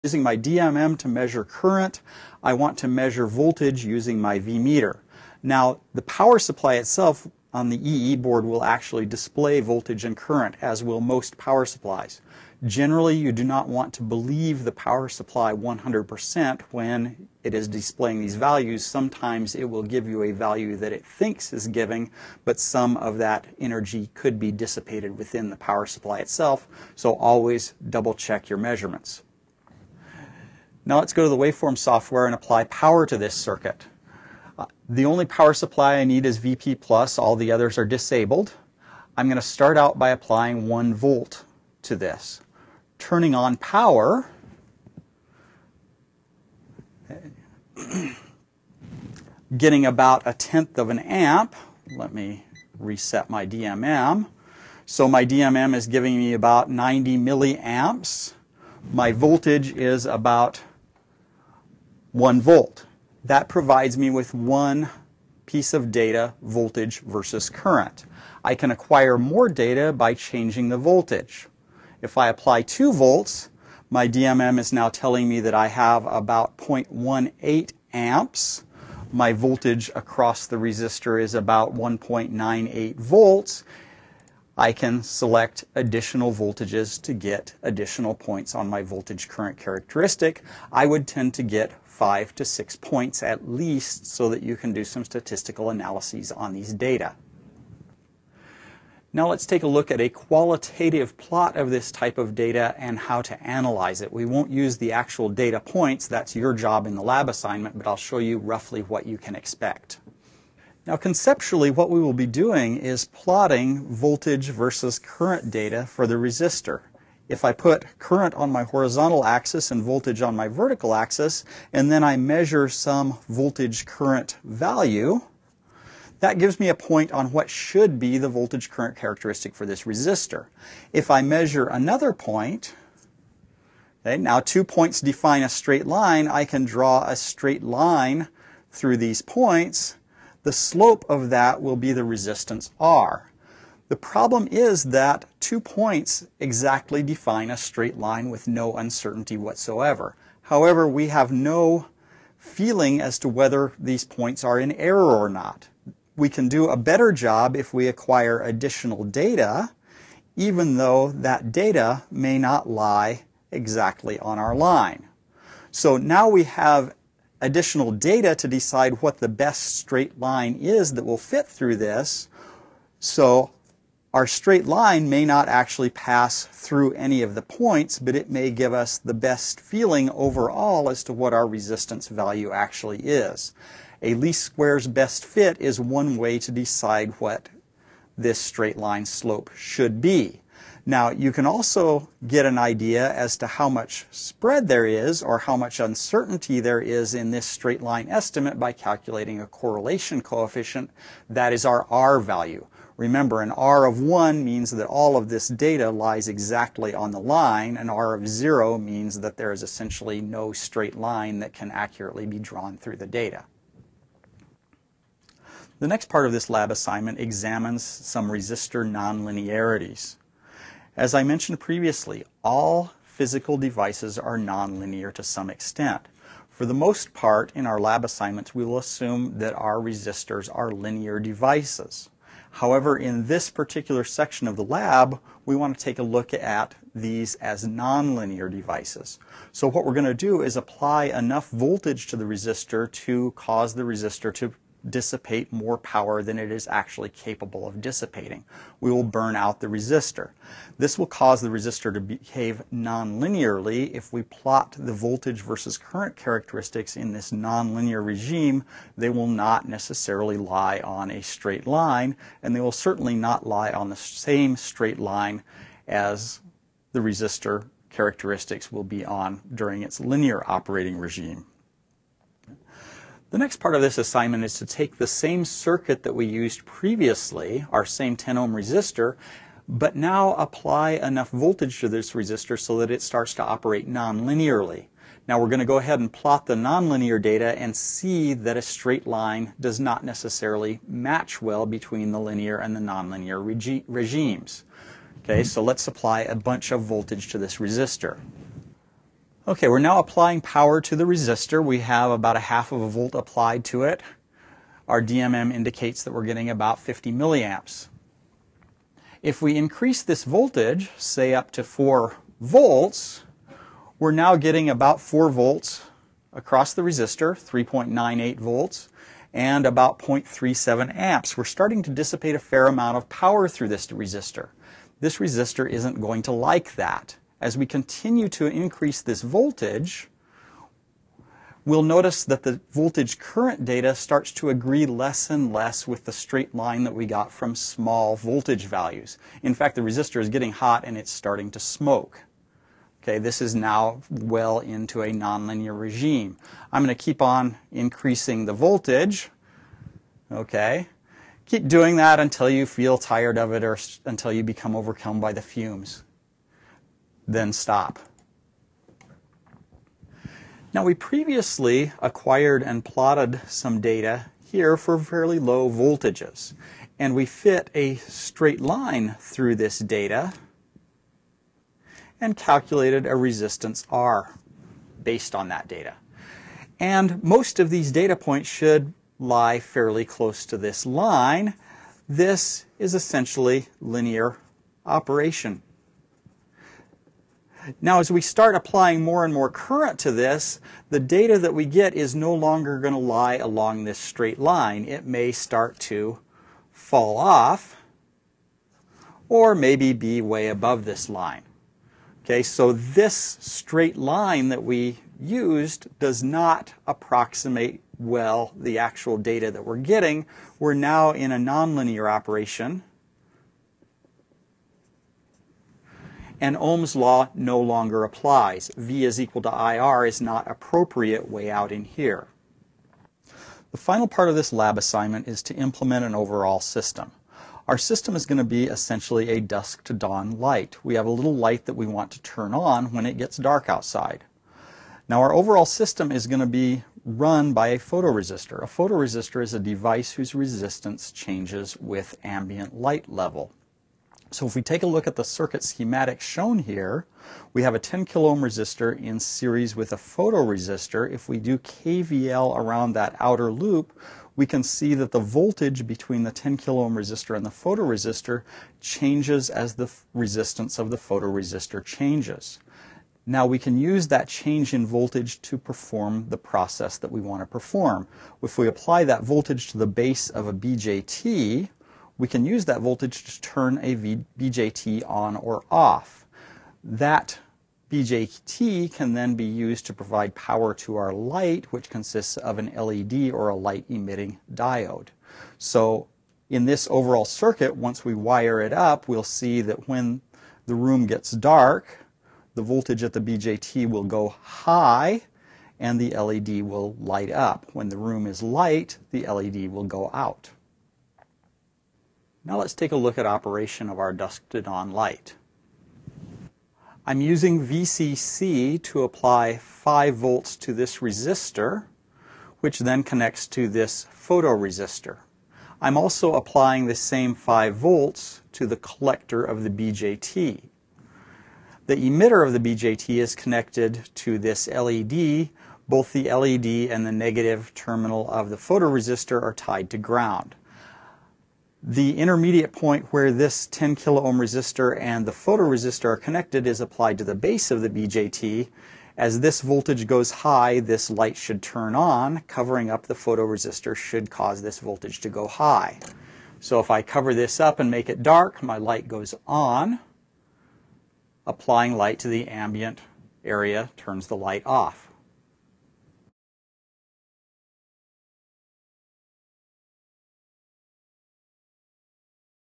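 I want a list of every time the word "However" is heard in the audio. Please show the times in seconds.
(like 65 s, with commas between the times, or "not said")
150 s, 232 s.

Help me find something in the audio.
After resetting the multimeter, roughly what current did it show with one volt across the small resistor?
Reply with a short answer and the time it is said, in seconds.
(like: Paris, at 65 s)
90 milliamps, at 56 s.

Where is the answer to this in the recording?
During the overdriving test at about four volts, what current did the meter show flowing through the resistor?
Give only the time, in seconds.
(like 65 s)
319 s.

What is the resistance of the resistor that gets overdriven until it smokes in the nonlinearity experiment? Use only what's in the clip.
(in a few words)
10 ohms.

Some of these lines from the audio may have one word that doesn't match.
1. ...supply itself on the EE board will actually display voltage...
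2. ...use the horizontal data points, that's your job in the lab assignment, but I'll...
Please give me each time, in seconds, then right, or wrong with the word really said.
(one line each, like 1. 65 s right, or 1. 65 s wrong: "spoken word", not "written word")
1. 6 s right
2. 104 s wrong: "actual", not "horizontal".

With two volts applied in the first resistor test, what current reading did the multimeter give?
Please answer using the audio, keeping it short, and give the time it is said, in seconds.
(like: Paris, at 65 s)
0.18 amps, at 76 s.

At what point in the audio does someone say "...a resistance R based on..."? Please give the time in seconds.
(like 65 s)
373 s.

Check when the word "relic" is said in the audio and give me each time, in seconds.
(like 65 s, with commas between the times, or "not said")
not said.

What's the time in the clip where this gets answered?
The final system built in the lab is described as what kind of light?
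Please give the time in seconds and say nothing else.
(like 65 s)
429 s.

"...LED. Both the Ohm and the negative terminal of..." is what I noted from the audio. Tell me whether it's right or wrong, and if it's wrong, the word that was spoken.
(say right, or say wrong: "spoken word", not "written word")
wrong: "LED", not "Ohm".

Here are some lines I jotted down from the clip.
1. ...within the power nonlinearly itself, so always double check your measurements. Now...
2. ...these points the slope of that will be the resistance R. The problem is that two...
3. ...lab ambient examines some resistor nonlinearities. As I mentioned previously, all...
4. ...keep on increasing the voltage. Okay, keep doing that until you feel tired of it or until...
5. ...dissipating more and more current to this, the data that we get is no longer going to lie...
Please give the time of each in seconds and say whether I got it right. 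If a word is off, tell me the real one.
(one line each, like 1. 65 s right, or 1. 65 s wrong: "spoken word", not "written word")
1. 25 s wrong: "supply", not "nonlinearly"
2. 138 s right
3. 216 s wrong: "assignment", not "ambient"
4. 347 s right
5. 388 s wrong: "applying", not "dissipating".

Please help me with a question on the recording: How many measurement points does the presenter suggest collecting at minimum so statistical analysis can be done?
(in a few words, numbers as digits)
5 to 6.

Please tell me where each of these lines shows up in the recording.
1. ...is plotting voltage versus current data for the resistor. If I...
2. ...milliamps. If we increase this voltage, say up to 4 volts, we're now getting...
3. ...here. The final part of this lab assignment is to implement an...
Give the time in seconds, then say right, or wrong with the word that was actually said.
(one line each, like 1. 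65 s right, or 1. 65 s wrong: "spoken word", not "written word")
1. 112 s right
2. 307 s right
3. 421 s right.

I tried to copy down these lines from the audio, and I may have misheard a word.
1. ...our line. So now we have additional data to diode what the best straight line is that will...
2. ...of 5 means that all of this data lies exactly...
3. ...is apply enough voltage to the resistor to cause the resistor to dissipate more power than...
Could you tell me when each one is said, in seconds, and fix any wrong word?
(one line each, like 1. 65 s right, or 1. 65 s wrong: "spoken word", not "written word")
1. 164 s wrong: "decide", not "diode"
2. 203 s wrong: "1", not "5"
3. 240 s right.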